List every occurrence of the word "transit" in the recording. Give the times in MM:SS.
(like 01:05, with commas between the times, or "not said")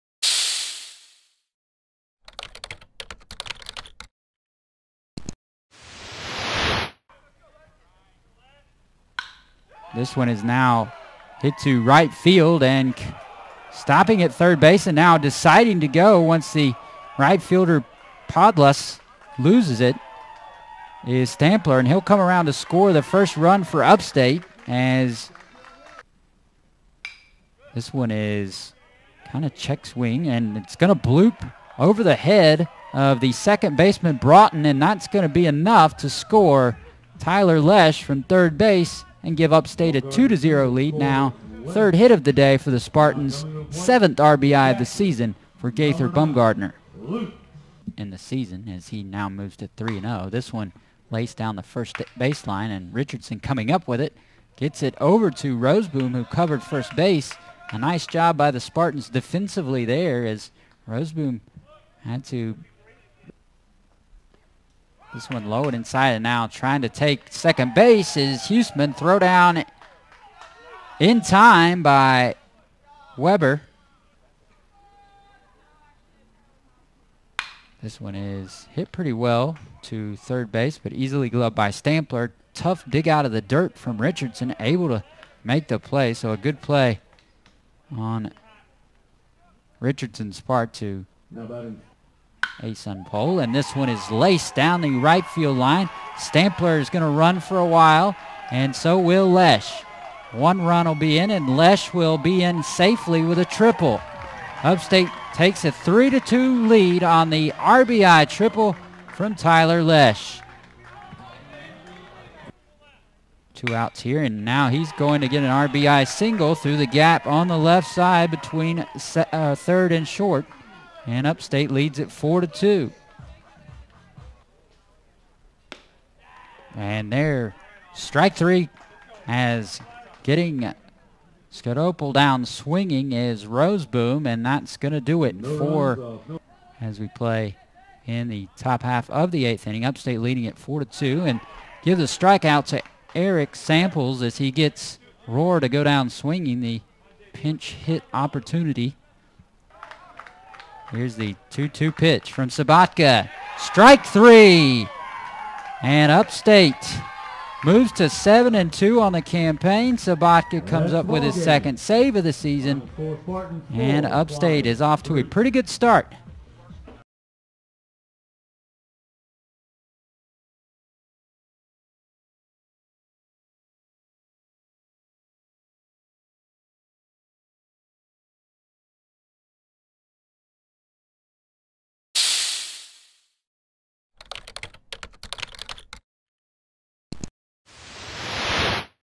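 not said.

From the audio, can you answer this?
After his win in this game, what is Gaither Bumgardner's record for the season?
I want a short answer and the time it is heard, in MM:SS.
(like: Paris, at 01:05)
3-0, at 00:49.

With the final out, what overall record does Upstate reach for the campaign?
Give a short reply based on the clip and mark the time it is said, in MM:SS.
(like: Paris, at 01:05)
7-2, at 02:38.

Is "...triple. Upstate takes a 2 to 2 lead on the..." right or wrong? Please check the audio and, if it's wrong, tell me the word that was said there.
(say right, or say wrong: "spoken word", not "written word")
wrong: "3", not "2".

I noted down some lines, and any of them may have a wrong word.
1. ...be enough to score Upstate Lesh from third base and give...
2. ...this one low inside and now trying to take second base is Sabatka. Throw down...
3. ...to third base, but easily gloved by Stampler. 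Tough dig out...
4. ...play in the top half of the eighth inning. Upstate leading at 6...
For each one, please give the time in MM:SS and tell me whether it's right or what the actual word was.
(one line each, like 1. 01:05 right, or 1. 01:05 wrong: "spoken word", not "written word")
1. 00:35 wrong: "Tyler", not "Upstate"
2. 01:05 wrong: "Houston", not "Sabatka"
3. 01:19 right
4. 02:17 wrong: "4", not "6".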